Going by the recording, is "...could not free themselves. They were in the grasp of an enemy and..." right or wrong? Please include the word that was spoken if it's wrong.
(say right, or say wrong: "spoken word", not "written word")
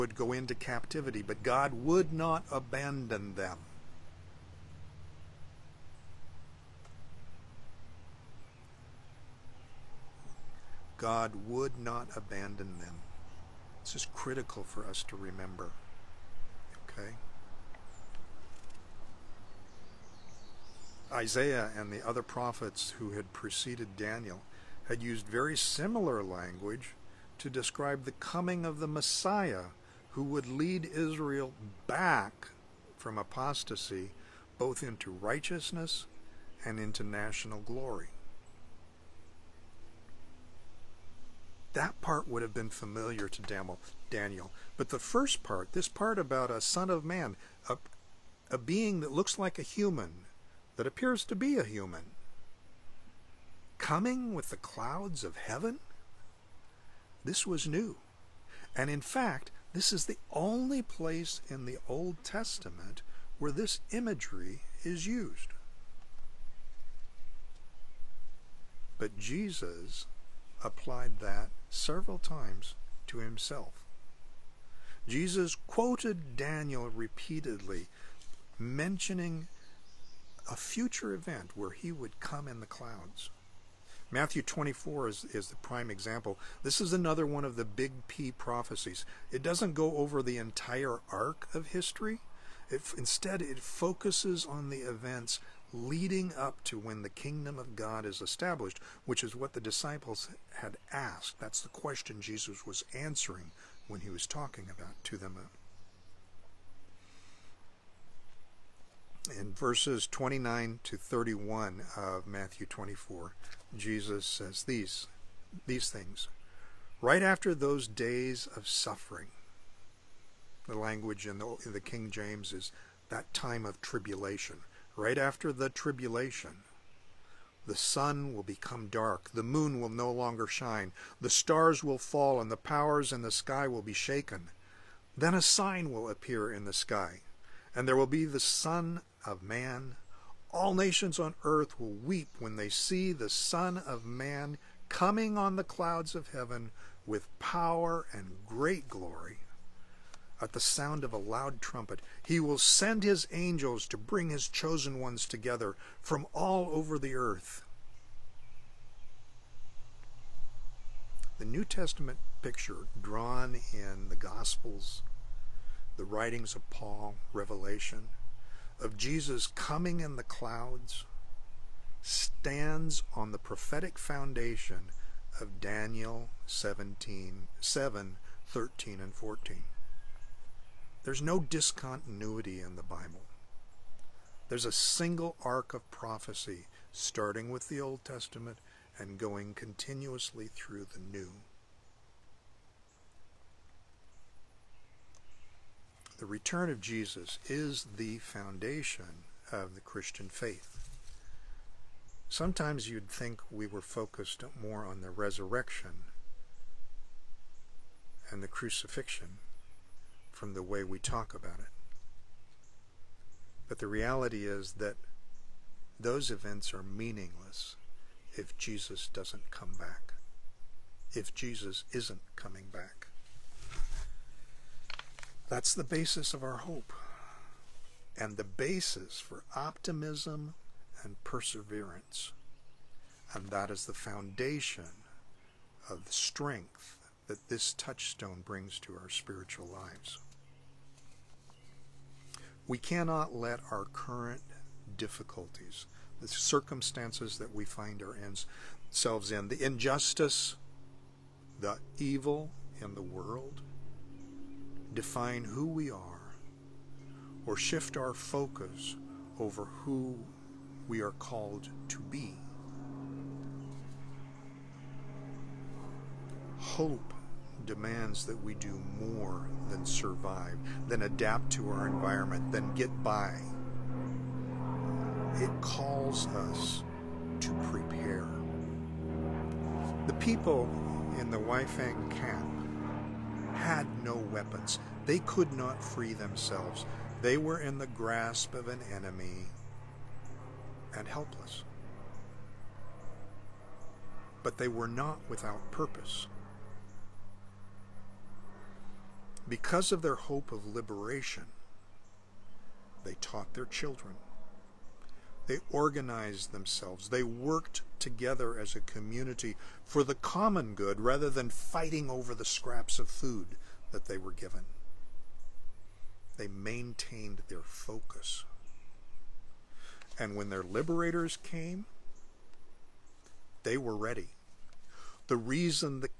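right.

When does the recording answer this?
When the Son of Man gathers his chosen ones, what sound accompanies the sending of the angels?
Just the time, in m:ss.
2:31.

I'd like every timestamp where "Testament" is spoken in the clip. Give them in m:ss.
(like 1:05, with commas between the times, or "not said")
1:02, 2:41, 3:08.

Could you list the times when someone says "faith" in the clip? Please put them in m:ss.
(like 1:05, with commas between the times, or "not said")
3:20.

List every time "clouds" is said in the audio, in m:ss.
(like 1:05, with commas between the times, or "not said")
0:54, 1:22, 2:25, 2:50.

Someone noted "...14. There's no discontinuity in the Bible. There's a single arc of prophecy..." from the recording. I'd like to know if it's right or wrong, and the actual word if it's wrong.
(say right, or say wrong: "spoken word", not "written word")
right.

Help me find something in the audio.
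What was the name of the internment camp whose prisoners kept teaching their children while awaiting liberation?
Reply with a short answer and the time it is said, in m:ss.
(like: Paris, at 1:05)
Weifang, at 4:41.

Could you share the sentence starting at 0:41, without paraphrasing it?
That part would have been familiar to Daniel.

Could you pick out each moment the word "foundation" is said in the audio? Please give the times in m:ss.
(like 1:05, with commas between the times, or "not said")
2:53, 3:18, 3:53.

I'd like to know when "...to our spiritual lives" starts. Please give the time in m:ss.
3:58.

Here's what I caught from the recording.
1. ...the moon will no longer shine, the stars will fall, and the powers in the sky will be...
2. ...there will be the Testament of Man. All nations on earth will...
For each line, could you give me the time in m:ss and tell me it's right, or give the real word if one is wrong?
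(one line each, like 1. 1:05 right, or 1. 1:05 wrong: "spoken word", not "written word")
1. 2:09 right
2. 2:17 wrong: "Son", not "Testament".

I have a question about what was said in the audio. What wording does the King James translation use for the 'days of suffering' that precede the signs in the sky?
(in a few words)
That time of tribulation.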